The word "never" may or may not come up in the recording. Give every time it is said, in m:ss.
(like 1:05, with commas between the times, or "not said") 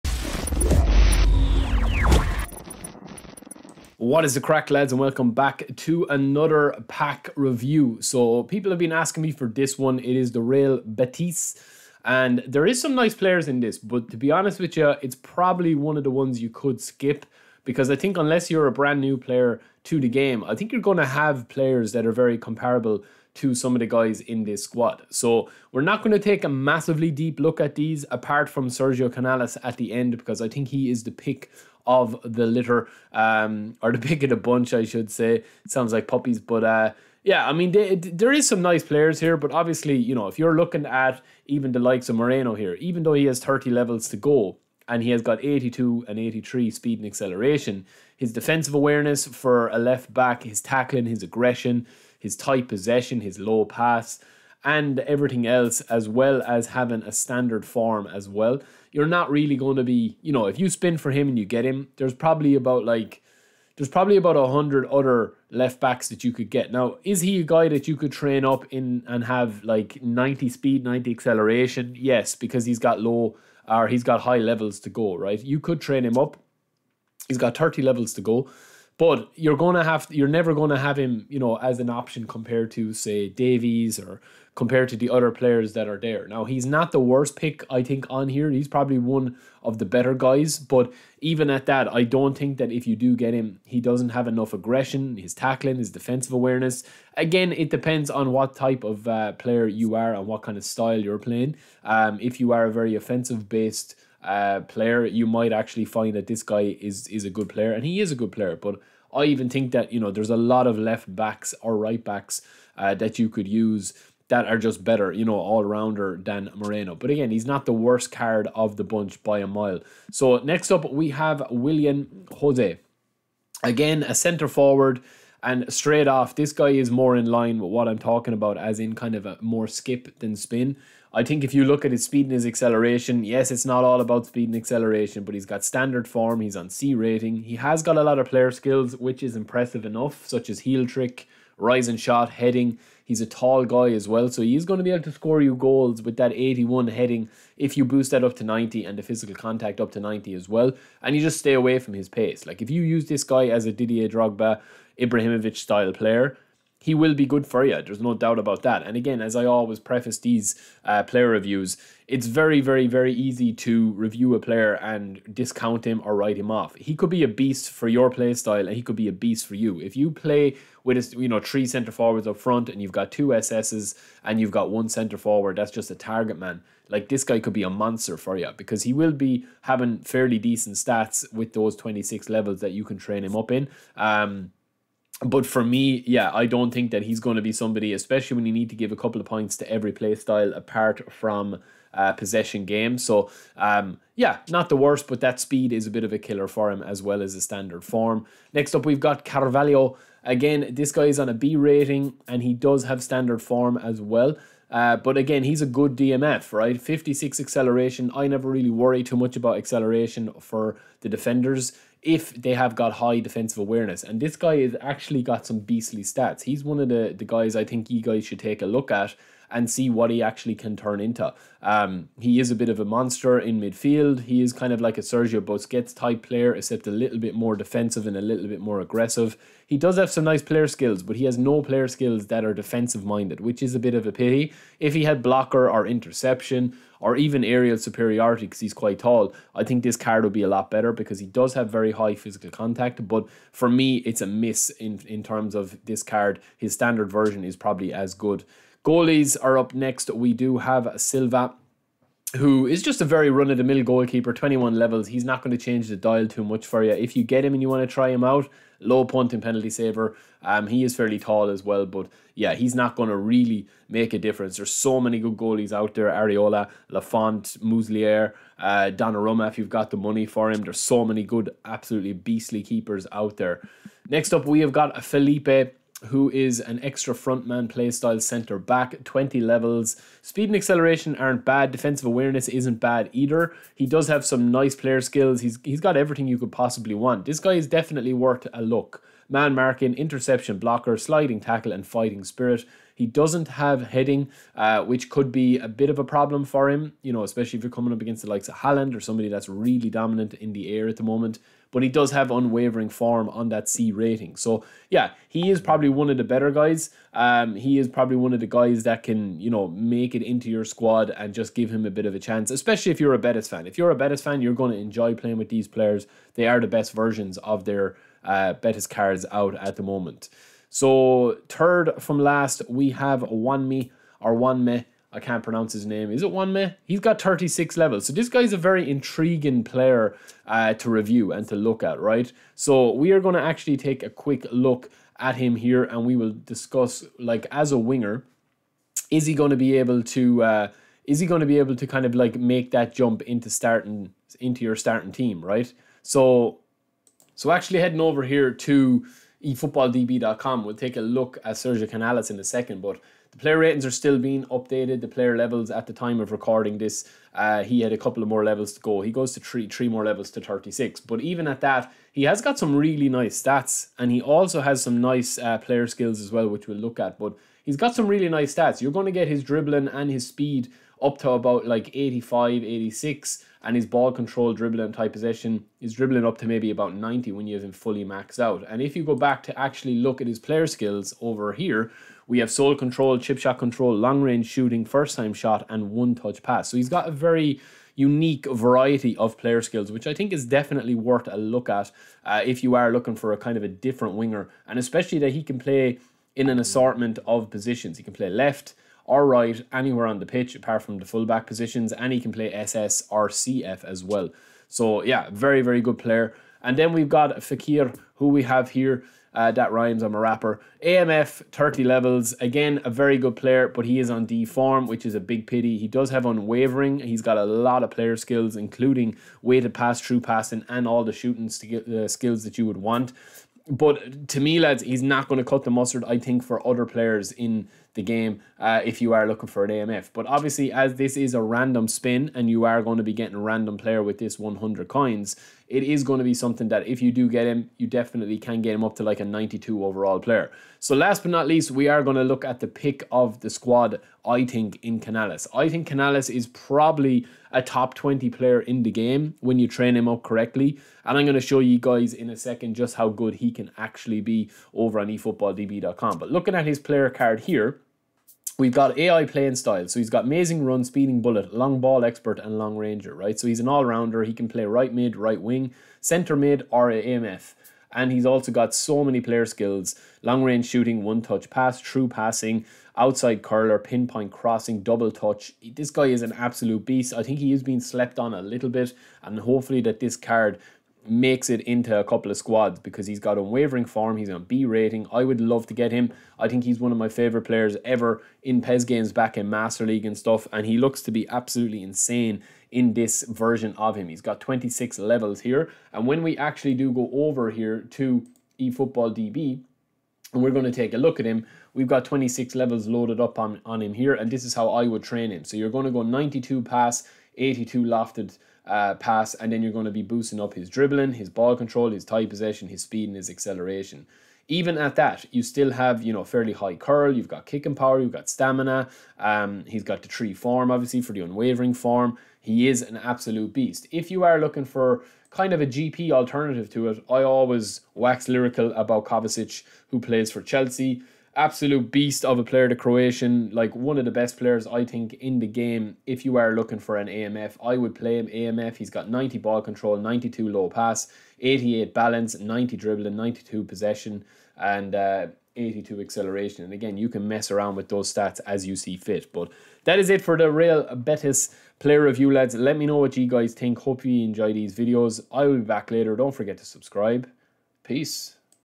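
1:20, 3:28.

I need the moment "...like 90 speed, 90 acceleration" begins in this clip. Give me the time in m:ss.
1:09.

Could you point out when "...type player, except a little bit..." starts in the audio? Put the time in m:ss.
3:45.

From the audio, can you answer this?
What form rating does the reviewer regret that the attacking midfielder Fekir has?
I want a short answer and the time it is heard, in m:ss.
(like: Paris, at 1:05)
D form, at 6:54.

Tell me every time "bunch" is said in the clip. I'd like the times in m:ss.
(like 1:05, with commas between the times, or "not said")
0:34, 1:58.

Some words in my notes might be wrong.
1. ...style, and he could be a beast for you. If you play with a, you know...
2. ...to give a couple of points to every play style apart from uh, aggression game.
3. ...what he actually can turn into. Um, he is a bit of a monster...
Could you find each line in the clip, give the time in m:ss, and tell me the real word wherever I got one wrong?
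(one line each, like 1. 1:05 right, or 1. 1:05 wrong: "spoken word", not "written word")
1. 2:48 right
2. 3:08 wrong: "possession", not "aggression"
3. 3:39 right.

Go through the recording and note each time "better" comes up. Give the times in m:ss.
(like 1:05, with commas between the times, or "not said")
1:29, 1:54, 4:00, 5:06.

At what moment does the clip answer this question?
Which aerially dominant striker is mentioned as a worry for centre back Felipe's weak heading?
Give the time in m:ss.
4:58.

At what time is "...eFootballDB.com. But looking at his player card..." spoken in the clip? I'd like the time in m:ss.
7:35.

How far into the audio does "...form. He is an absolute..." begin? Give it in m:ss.
8:41.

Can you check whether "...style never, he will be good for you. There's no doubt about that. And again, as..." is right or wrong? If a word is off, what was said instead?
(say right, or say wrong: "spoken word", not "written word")
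wrong: "player", not "never".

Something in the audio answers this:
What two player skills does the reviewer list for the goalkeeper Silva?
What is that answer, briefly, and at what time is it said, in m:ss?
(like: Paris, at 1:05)
Low punt and penalty saver, at 4:18.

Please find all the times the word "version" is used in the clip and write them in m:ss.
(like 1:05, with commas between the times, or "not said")
4:07, 5:16, 8:13.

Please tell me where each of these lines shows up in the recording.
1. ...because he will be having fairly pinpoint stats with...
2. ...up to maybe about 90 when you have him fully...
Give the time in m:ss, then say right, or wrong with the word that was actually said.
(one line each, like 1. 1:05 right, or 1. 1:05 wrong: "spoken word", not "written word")
1. 2:58 wrong: "decent", not "pinpoint"
2. 6:16 right.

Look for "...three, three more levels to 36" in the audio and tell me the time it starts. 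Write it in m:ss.
5:59.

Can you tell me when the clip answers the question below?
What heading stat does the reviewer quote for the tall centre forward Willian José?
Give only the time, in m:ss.
2:26.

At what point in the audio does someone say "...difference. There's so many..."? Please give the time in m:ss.
4:24.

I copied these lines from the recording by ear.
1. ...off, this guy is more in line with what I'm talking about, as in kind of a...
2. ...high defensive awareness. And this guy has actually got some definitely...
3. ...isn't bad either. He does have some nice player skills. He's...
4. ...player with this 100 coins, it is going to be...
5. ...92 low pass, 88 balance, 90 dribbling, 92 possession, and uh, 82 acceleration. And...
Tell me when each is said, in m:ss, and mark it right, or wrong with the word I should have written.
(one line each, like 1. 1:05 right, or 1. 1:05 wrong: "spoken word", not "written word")
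1. 2:06 right
2. 3:32 wrong: "beastly", not "definitely"
3. 4:42 right
4. 7:13 right
5. 8:59 right.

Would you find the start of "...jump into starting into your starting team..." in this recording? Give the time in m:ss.
5:42.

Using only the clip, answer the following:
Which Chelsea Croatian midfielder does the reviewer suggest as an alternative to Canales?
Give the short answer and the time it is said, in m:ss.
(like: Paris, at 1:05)
Kovacic, at 8:49.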